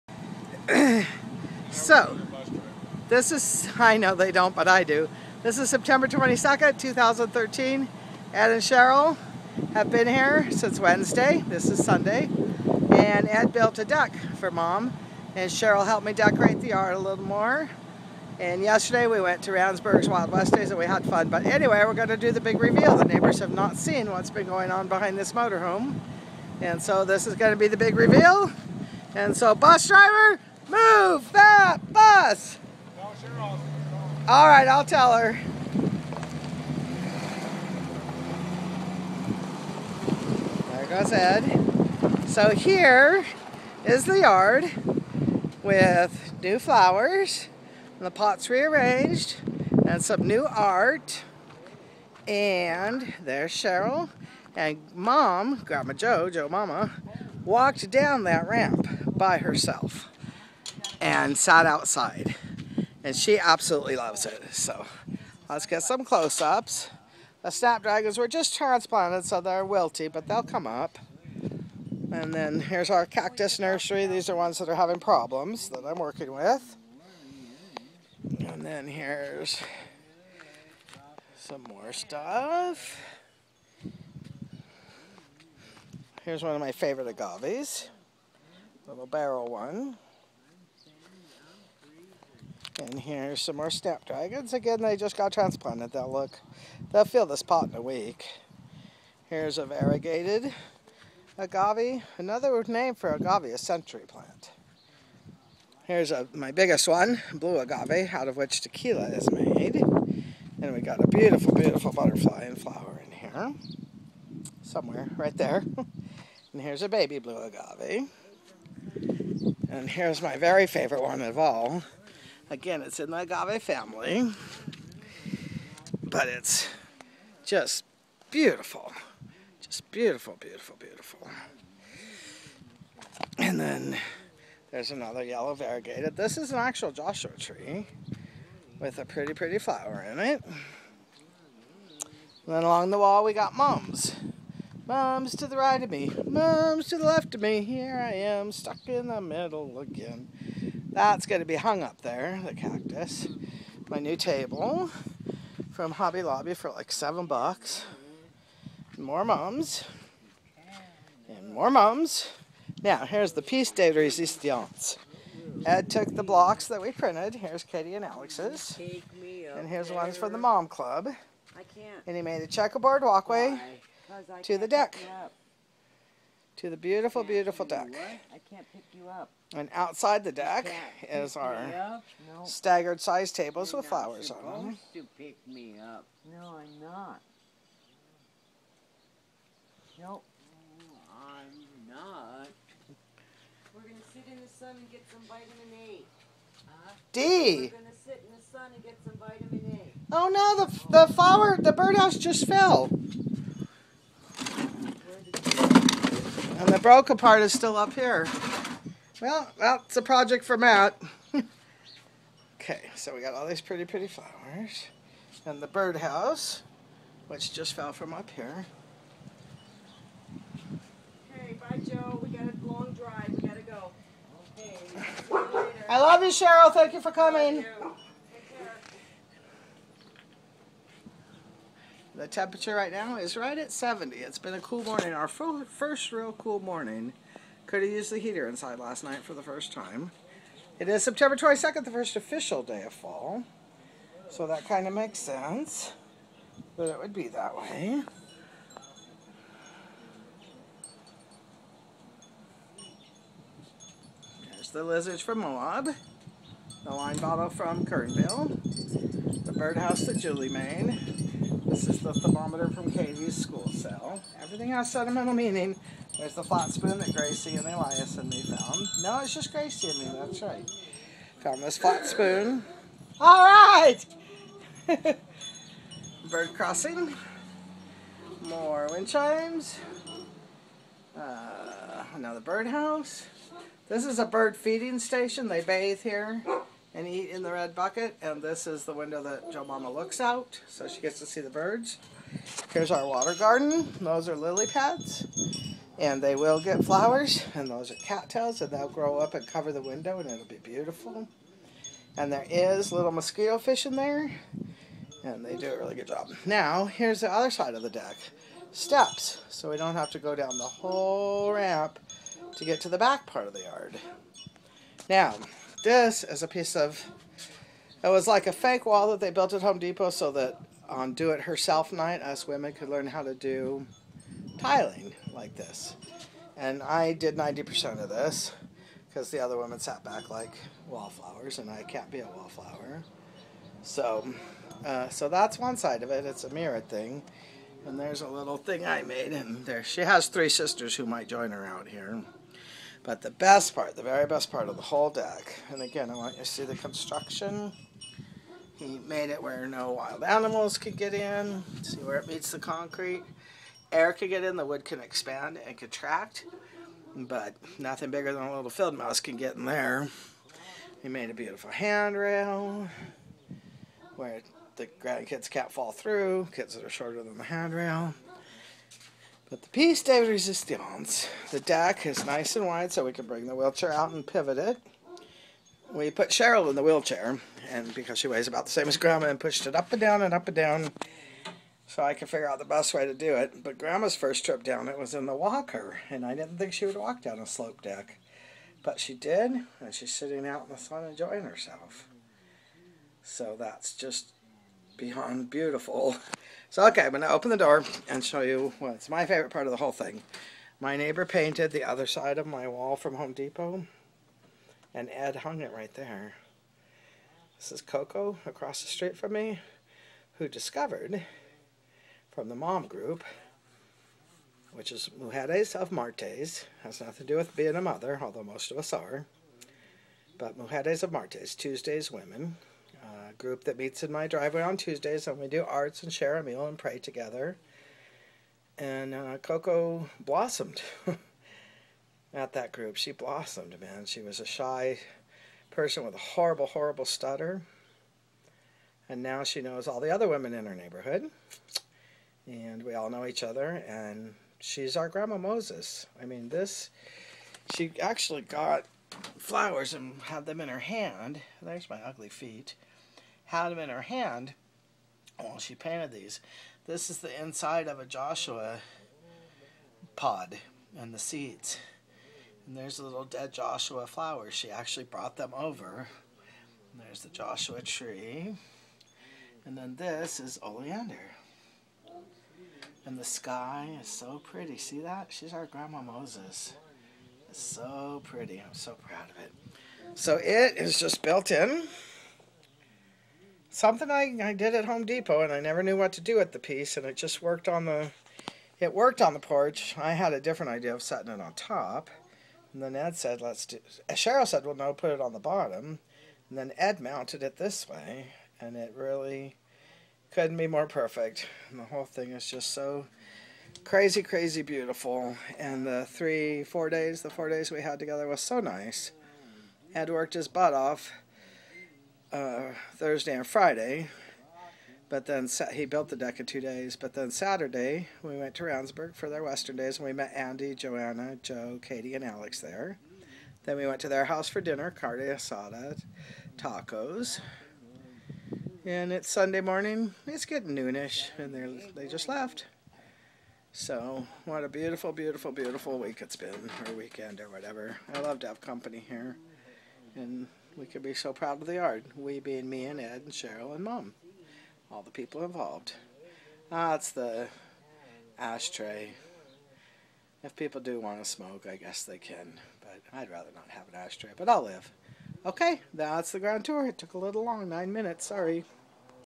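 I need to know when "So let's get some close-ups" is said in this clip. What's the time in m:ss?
1:04.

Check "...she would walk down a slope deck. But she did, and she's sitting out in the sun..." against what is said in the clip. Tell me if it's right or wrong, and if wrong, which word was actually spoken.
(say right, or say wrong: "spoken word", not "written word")
right.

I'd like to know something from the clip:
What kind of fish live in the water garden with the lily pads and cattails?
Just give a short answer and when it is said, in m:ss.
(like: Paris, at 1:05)
Mosquito fish, at 5:03.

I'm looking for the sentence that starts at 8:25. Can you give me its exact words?
And the three, four days, the four days we had together was so nice.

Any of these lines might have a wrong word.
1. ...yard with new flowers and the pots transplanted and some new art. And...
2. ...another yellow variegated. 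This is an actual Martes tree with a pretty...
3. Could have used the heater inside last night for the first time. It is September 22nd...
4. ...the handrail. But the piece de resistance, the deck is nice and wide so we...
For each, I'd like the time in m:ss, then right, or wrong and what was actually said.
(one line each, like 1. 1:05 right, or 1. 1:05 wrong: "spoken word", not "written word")
1. 0:44 wrong: "rearranged", not "transplanted"
2. 2:14 wrong: "Joshua", not "Martes"
3. 3:57 right
4. 6:07 right.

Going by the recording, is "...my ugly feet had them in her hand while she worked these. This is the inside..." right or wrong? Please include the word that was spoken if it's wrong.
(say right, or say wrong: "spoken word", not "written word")
wrong: "painted", not "worked".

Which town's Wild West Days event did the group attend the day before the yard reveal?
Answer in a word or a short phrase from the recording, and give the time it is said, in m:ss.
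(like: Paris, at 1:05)
Randsburg, at 0:19.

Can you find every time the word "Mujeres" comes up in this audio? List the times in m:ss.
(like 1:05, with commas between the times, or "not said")
6:55, 7:00.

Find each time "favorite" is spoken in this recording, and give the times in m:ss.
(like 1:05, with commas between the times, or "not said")
1:26, 2:00, 6:39.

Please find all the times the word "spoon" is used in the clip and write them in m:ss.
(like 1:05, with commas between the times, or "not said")
4:26, 4:32.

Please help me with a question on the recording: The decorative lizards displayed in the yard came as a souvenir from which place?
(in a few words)
Moab.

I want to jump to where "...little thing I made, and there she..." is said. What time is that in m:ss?
5:38.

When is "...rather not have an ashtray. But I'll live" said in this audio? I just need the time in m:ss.
9:13.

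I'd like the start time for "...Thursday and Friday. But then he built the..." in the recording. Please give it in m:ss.
8:32.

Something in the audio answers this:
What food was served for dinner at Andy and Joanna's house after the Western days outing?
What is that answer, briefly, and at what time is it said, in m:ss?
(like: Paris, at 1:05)
Carne asada tacos, at 8:44.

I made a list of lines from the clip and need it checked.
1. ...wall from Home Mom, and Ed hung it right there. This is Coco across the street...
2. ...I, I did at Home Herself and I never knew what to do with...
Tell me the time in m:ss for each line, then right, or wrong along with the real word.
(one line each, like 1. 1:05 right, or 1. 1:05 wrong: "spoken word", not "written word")
1. 6:42 wrong: "Depot", not "Mom"
2. 8:04 wrong: "Depot", not "Herself".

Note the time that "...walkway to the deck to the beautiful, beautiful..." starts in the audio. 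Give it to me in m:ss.
2:53.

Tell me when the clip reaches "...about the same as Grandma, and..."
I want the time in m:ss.
6:18.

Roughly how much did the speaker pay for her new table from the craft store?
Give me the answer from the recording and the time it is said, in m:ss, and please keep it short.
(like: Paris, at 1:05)
$7, at 2:36.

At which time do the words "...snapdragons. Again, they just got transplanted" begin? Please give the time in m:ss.
1:33.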